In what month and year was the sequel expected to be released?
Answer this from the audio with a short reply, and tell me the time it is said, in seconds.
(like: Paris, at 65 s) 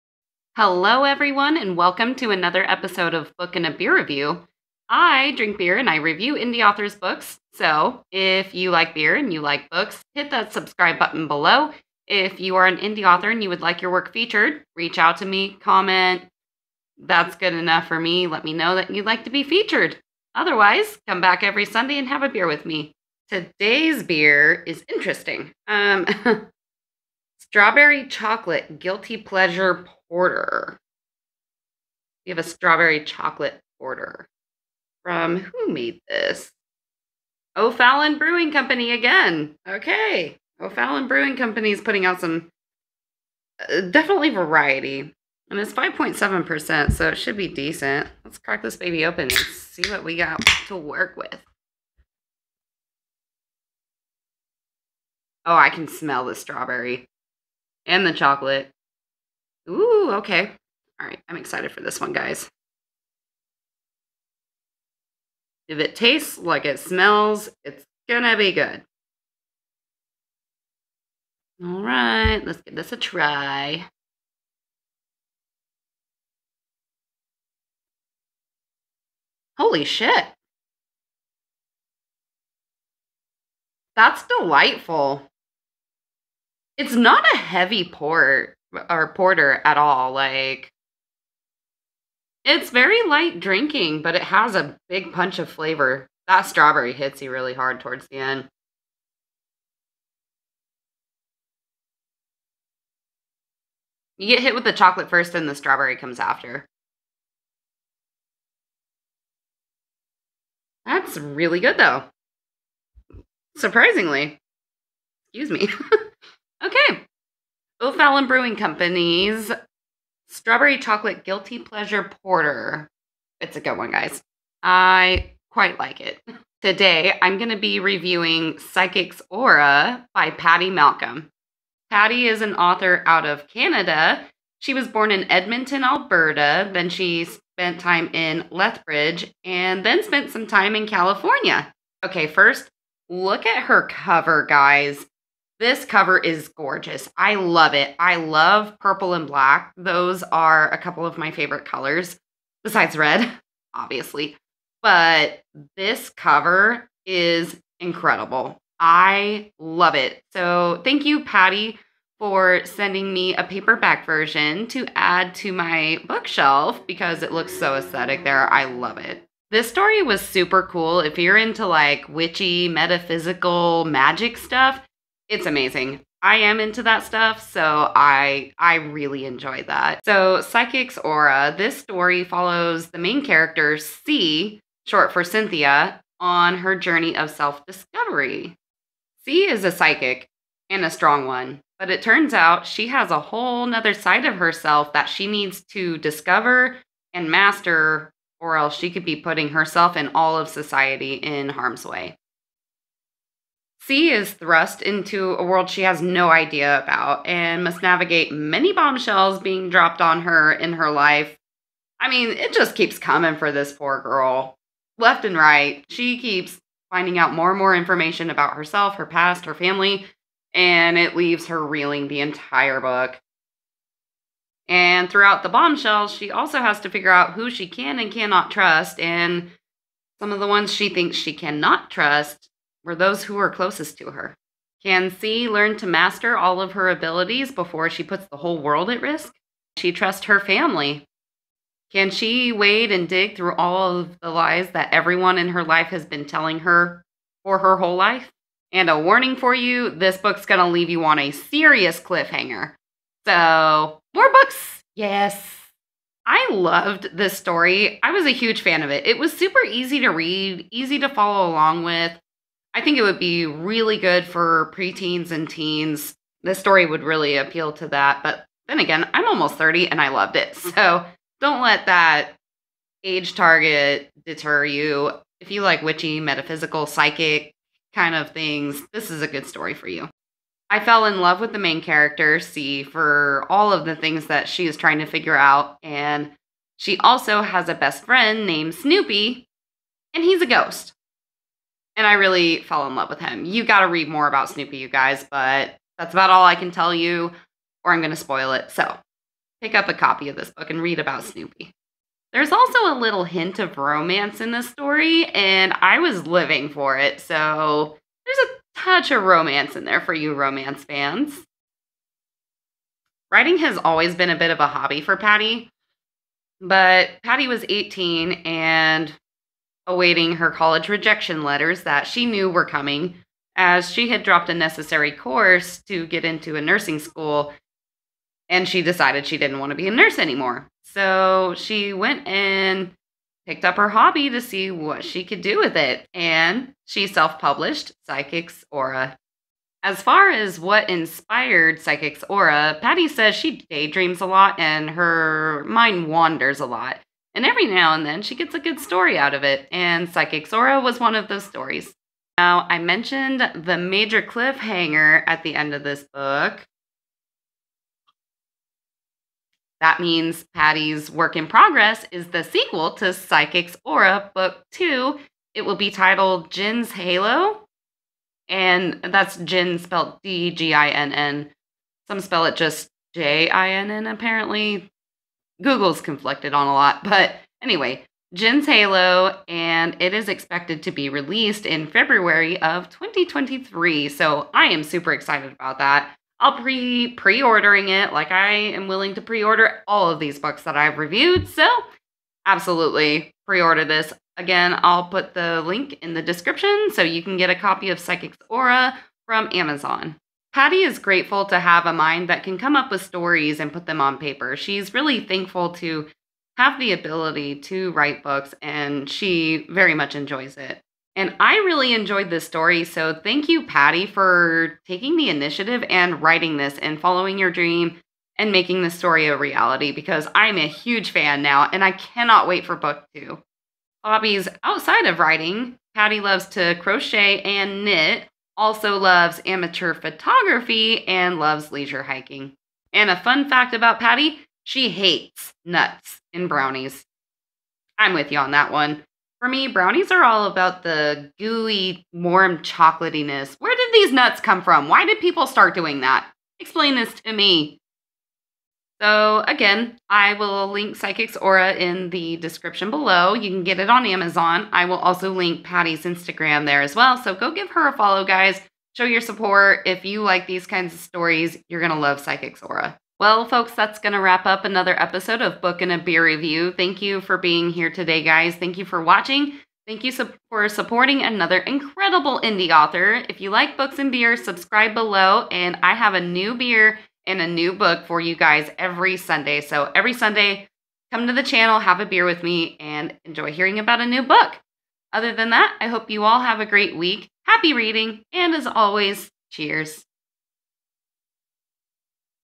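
February 2023, at 381 s.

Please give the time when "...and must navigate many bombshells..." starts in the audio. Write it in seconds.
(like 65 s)
207 s.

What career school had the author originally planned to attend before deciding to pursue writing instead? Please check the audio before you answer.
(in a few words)
nursing school.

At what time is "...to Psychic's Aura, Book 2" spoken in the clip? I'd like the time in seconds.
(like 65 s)
362 s.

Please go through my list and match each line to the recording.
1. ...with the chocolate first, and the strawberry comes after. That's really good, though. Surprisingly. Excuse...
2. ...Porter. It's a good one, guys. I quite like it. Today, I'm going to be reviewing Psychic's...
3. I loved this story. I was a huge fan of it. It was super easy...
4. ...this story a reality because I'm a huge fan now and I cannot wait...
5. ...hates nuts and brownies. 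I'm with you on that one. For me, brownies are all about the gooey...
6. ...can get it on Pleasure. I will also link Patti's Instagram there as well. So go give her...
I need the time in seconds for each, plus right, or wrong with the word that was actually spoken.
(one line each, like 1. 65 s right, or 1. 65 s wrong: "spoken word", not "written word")
1. 104 s right
2. 122 s right
3. 256 s right
4. 418 s right
5. 434 s right
6. 453 s wrong: "Amazon", not "Pleasure".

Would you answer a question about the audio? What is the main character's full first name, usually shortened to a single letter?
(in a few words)
Cynthia.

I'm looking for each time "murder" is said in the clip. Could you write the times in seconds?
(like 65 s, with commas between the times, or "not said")
not said.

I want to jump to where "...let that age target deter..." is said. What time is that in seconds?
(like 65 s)
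271 s.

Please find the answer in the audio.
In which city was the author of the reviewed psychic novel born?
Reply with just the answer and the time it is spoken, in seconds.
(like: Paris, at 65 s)
Edmonton, at 135 s.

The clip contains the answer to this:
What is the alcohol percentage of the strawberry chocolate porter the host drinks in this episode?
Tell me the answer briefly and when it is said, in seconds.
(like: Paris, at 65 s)
5.7%, at 45 s.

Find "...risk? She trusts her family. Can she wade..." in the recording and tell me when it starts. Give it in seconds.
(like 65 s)
239 s.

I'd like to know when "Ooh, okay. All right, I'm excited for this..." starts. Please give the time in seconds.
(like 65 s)
59 s.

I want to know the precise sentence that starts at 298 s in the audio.
So pick up a copy of this book and read about Snoopy.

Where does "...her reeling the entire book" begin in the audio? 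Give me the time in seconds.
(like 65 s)
221 s.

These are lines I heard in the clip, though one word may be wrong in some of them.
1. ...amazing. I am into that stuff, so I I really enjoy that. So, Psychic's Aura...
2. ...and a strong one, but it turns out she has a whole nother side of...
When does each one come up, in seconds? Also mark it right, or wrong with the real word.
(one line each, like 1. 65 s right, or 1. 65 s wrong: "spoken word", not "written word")
1. 175 s right
2. 190 s right.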